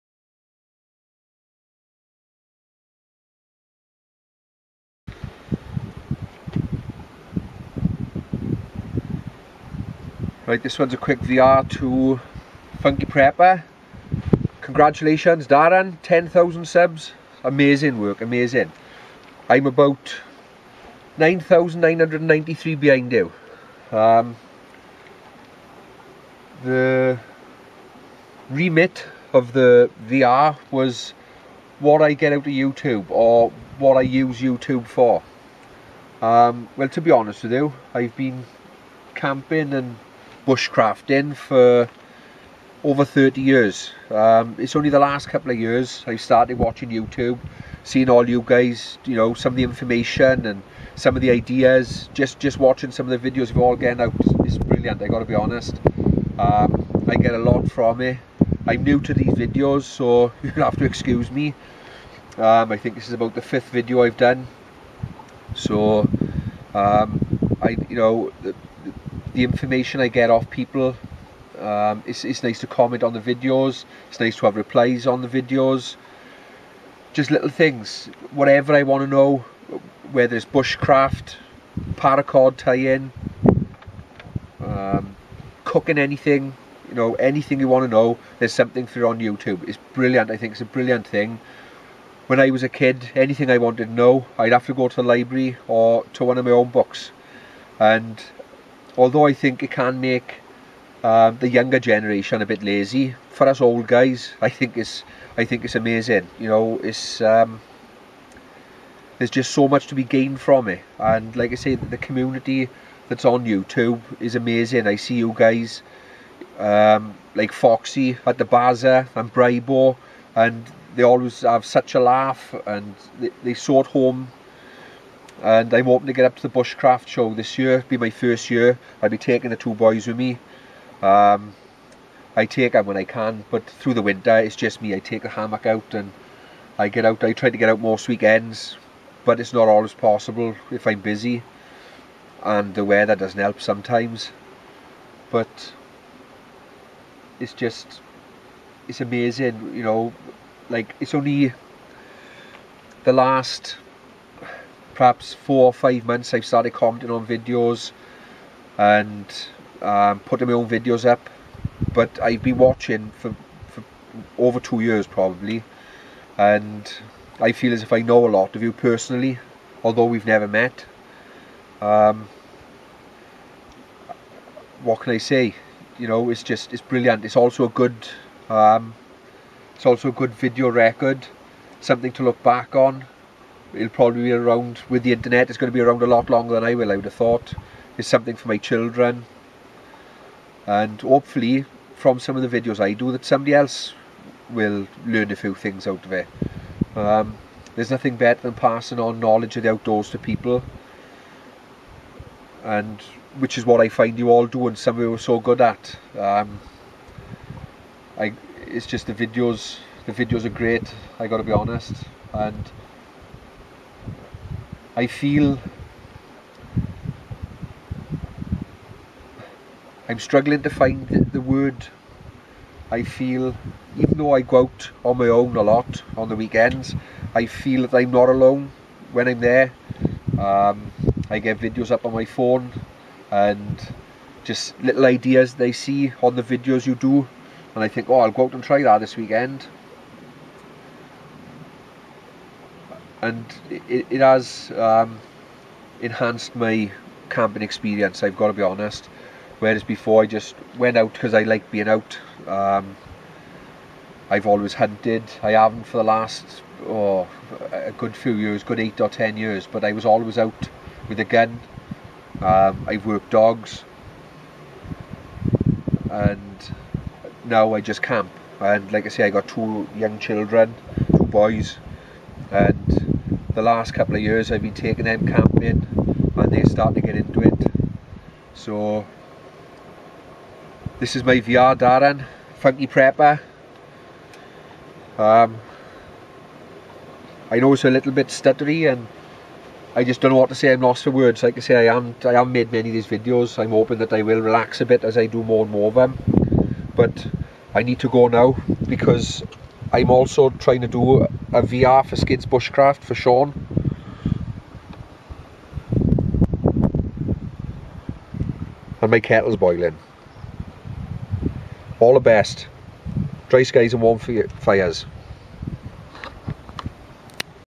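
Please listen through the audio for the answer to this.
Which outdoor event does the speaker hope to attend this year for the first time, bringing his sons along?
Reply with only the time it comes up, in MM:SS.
02:06.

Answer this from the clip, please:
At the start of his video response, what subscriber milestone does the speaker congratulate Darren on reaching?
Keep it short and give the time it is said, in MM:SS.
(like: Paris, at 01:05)
10,000, at 00:16.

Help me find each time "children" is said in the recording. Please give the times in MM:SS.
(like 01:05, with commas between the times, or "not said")
03:08, 04:30.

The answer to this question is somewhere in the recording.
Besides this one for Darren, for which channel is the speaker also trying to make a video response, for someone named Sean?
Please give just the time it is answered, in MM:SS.
05:02.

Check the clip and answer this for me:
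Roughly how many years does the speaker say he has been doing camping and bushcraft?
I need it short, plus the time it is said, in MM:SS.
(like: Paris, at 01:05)
over 30 years, at 00:42.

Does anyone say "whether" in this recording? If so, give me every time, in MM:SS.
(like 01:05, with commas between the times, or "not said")
01:20.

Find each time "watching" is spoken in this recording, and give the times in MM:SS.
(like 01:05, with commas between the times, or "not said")
00:46, 00:52, 02:42.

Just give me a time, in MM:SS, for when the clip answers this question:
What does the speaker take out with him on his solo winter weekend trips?
02:15.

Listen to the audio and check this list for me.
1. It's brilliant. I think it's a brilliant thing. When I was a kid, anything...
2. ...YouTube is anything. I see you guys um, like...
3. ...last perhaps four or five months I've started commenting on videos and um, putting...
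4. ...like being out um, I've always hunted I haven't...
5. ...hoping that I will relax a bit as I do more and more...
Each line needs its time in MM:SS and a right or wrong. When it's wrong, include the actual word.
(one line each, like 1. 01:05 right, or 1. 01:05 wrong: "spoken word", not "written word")
1. 01:29 right
2. 01:53 wrong: "amazing", not "anything"
3. 02:33 right
4. 04:11 right
5. 04:53 right.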